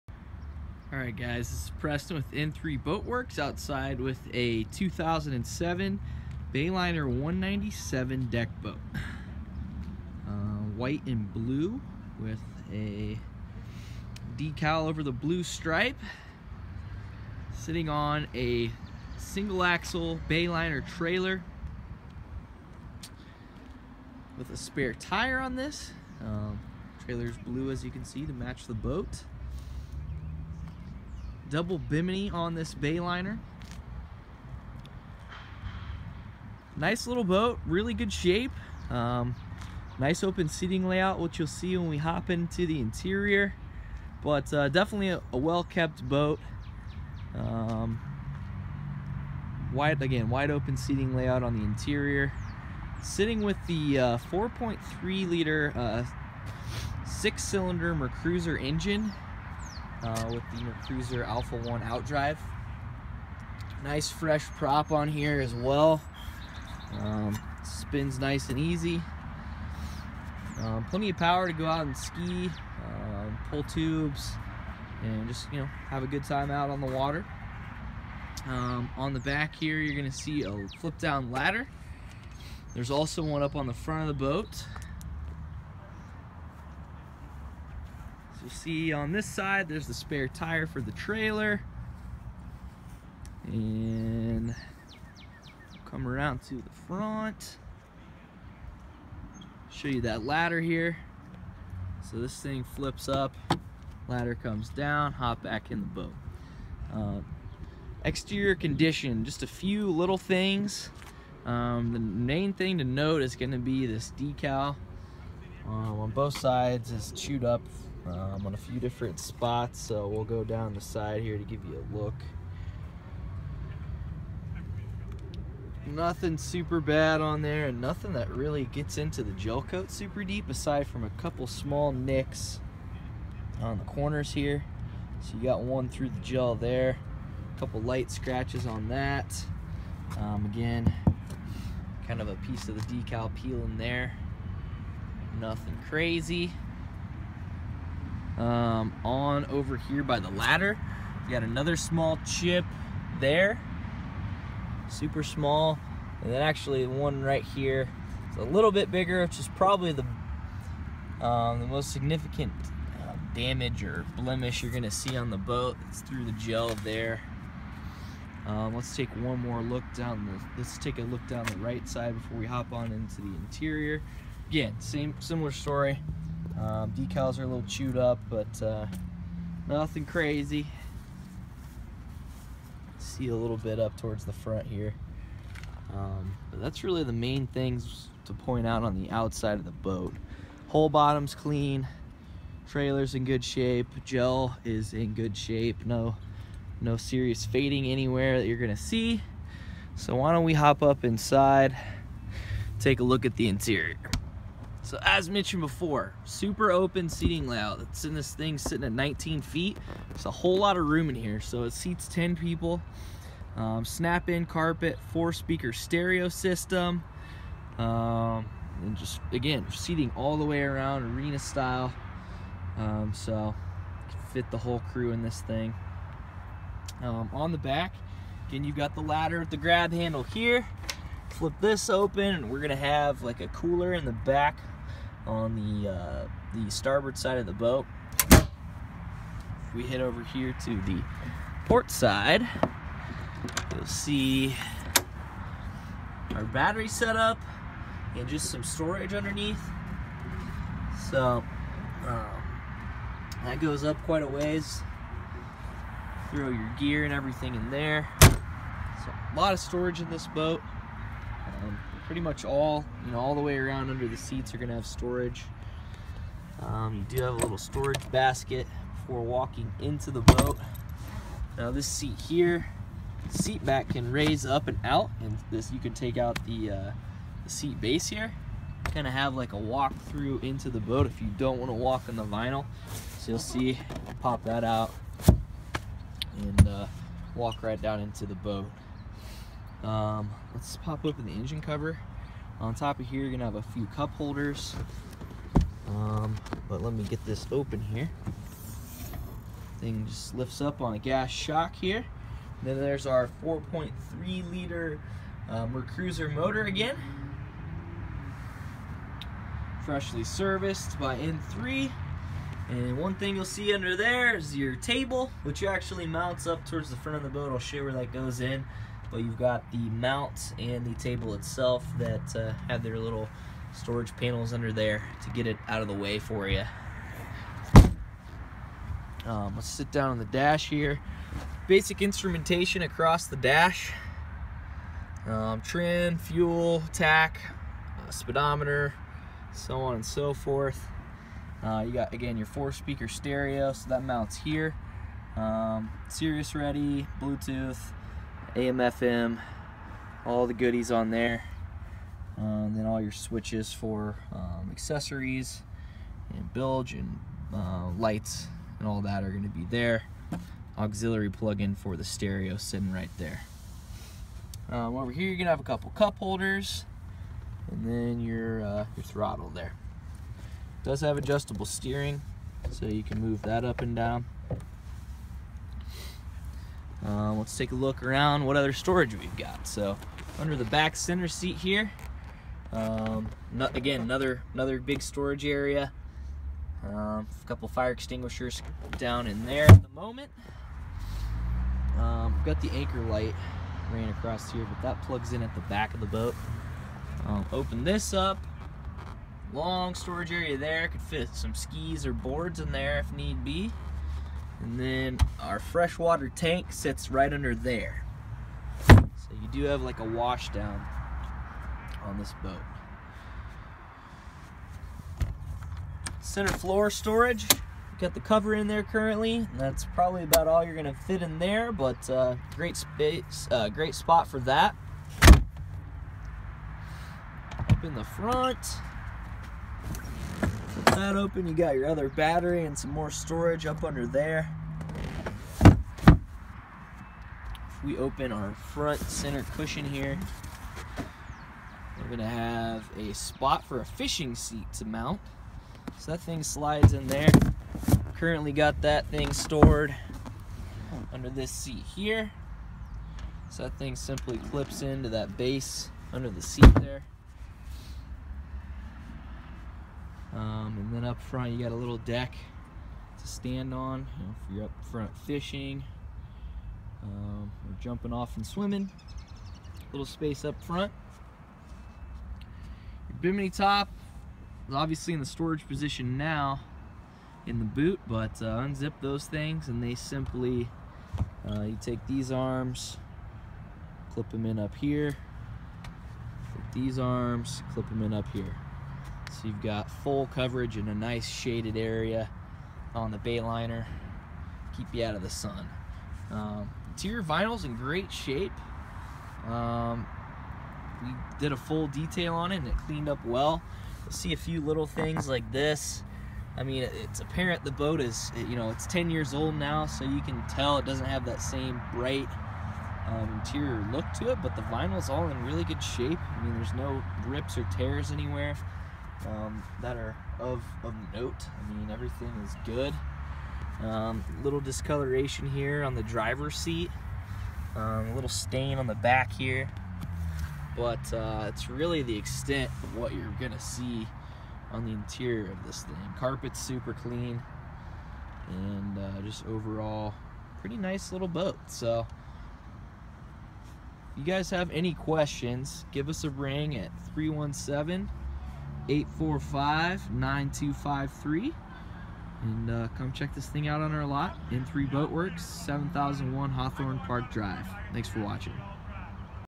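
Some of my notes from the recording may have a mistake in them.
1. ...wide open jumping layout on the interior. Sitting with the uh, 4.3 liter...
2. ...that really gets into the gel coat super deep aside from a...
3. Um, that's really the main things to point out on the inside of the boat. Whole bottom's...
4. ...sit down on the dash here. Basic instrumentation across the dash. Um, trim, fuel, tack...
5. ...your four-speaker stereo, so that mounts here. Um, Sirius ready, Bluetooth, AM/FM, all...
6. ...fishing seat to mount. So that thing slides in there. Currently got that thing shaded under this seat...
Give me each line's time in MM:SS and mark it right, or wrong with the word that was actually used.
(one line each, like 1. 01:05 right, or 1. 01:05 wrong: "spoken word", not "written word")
1. 00:50 wrong: "seating", not "jumping"
2. 02:08 right
3. 03:05 wrong: "outside", not "inside"
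4. 05:29 right
5. 05:42 right
6. 07:23 wrong: "stored", not "shaded".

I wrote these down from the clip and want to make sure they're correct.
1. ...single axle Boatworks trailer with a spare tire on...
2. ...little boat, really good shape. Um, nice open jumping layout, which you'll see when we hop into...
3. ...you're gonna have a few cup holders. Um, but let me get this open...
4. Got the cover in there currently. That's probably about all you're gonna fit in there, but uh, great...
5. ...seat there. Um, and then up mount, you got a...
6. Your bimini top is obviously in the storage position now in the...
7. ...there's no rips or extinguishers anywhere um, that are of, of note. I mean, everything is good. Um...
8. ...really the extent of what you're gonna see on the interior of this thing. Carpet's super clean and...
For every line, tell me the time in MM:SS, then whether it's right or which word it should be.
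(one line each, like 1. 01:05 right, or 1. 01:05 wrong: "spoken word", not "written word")
1. 00:19 wrong: "Bayliner", not "Boatworks"
2. 00:37 wrong: "seating", not "jumping"
3. 04:53 right
4. 06:57 right
5. 07:36 wrong: "front", not "mount"
6. 07:53 right
7. 08:36 wrong: "tears", not "extinguishers"
8. 08:51 right.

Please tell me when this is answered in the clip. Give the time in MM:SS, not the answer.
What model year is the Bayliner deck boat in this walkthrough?
00:04.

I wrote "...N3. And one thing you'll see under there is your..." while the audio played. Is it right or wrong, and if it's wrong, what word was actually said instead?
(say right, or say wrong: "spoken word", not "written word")
right.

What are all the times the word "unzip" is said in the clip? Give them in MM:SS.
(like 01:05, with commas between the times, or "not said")
07:58.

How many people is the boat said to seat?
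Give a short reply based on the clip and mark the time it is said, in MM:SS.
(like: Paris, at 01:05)
10, at 03:32.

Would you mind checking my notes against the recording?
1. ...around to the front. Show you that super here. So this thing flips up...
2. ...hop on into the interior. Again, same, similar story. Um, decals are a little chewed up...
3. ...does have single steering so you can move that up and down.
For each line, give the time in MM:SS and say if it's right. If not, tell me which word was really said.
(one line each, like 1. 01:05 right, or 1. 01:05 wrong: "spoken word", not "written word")
1. 01:36 wrong: "ladder", not "super"
2. 02:52 right
3. 06:10 wrong: "adjustable", not "single".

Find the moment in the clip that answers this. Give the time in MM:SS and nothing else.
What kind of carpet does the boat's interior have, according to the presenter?
03:33.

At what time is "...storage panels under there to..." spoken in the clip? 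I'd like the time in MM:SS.
05:23.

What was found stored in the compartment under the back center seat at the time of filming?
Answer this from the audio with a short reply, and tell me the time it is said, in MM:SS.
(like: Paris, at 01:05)
fire extinguishers, at 06:27.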